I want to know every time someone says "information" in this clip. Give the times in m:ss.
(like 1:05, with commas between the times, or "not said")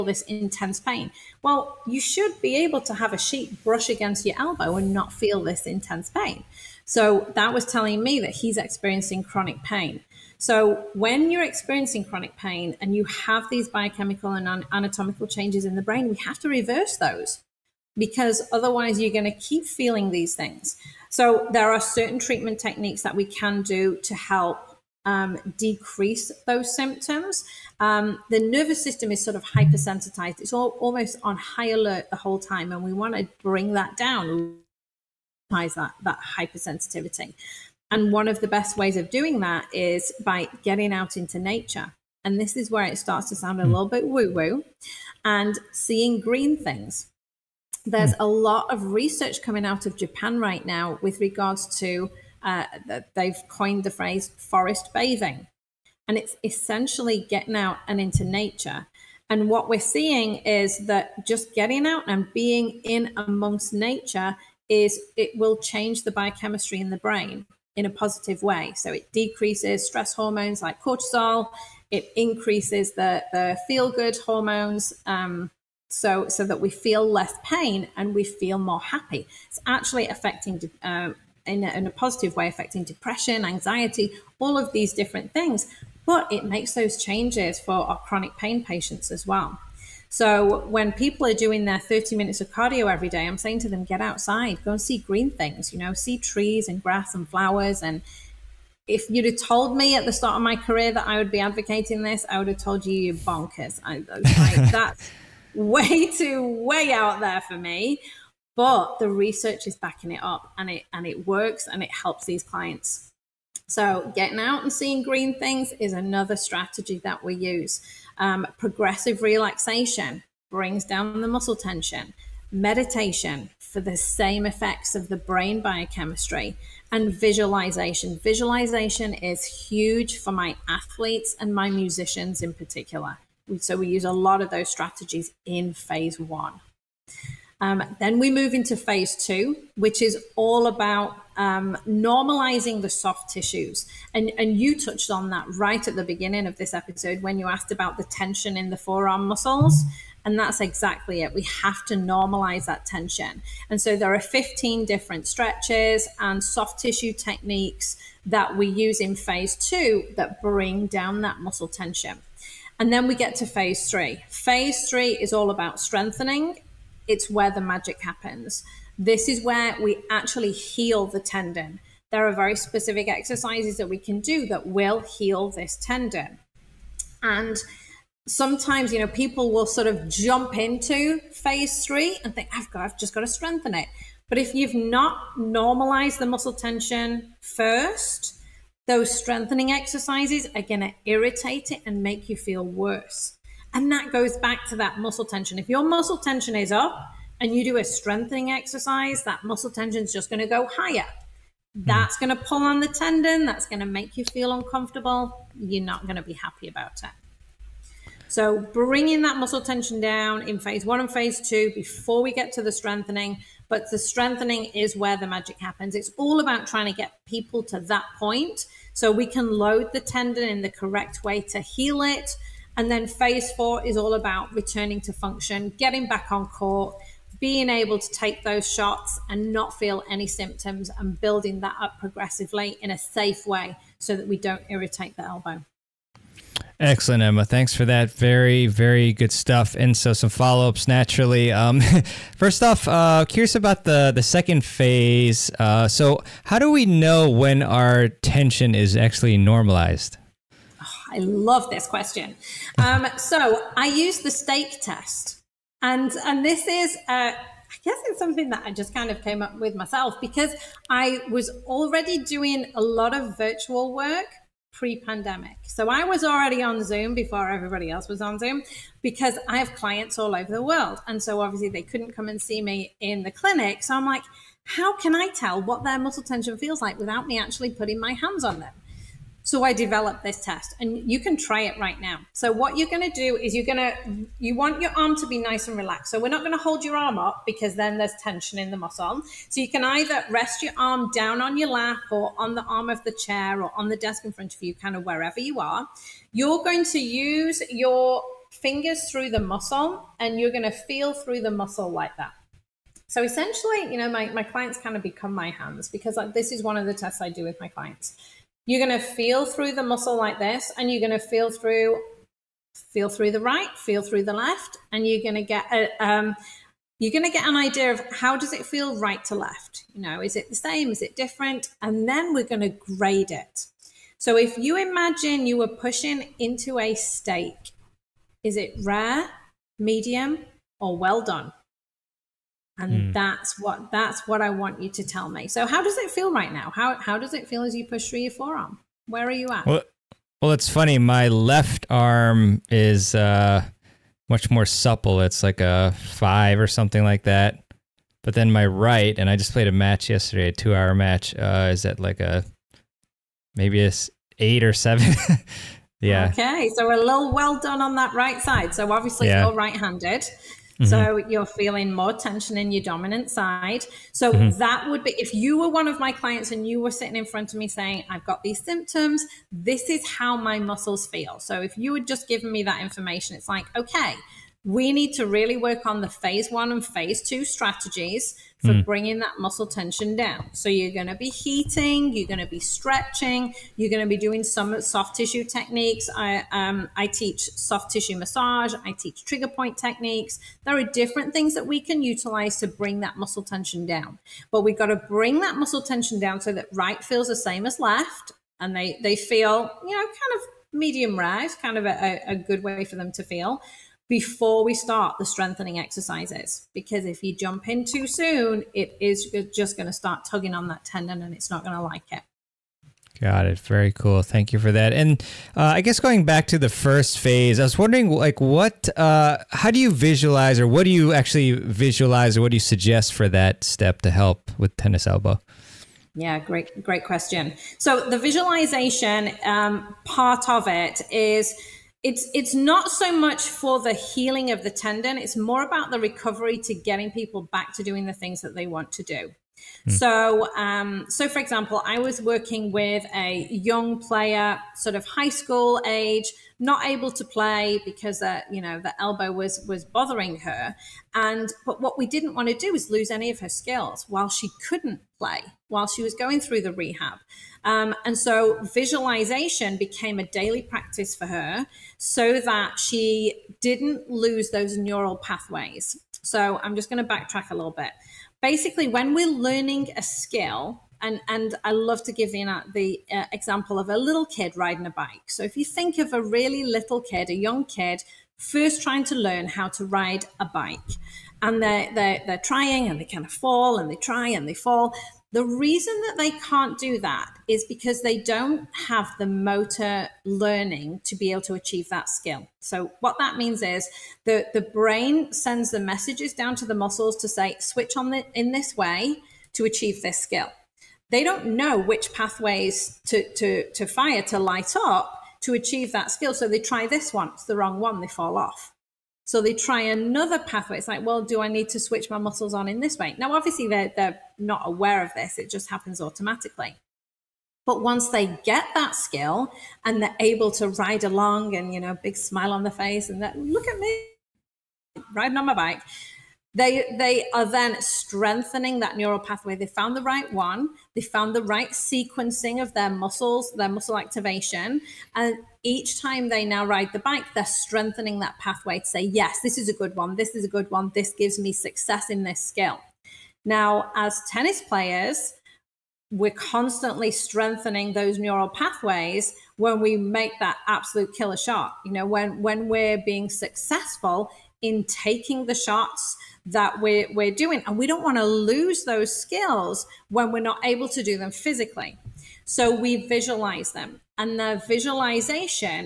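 6:12.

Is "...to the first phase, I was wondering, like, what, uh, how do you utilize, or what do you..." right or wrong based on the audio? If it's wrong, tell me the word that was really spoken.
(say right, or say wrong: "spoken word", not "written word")
wrong: "visualize", not "utilize".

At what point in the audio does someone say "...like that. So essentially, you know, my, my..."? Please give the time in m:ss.
5:01.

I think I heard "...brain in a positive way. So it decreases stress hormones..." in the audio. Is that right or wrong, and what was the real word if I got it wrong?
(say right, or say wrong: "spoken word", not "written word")
right.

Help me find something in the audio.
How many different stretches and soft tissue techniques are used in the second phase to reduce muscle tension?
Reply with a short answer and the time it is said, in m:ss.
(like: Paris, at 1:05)
15, at 2:34.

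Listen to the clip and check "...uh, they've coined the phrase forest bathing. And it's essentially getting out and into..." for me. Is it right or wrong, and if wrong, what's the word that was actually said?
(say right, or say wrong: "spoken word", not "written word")
right.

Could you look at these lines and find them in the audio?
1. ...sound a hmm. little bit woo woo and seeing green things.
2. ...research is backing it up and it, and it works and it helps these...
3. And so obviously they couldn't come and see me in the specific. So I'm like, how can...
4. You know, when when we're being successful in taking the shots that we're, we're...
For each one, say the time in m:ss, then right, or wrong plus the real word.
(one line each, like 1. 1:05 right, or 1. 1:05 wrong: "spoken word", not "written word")
1. 0:43 right
2. 1:49 right
3. 4:31 wrong: "clinic", not "specific"
4. 9:11 right.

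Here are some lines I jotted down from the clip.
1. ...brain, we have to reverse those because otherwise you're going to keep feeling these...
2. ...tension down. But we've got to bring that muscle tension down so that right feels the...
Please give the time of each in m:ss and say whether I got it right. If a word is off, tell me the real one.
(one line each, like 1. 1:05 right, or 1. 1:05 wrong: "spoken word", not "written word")
1. 0:15 right
2. 6:33 right.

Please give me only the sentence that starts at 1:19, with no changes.
It's actually affecting de- uh, in, a, in a positive way, affecting depression, anxiety, all of these different things.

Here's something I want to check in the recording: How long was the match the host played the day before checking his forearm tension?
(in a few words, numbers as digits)
2 hours.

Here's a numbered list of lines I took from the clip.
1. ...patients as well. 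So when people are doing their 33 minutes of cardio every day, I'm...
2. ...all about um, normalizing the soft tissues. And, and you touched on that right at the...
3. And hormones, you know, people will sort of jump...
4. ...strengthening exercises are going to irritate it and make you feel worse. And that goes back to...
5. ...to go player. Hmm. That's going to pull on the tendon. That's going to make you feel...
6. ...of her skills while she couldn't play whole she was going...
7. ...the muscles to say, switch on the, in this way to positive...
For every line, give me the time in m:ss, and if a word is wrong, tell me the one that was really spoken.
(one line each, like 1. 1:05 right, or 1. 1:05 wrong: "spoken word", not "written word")
1. 1:28 wrong: "30", not "33"
2. 2:20 right
3. 2:57 wrong: "sometimes", not "hormones"
4. 3:09 right
5. 3:20 wrong: "higher", not "player"
6. 7:33 wrong: "while", not "whole"
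7. 8:16 wrong: "achieve", not "positive".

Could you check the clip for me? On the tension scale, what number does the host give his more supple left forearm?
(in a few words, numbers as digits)
5.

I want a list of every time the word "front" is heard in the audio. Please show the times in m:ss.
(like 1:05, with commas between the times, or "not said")
4:54, 6:07.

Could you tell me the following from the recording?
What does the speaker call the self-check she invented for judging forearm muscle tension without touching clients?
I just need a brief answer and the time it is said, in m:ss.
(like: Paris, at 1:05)
The steak test, at 4:14.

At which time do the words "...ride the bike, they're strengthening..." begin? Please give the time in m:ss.
8:56.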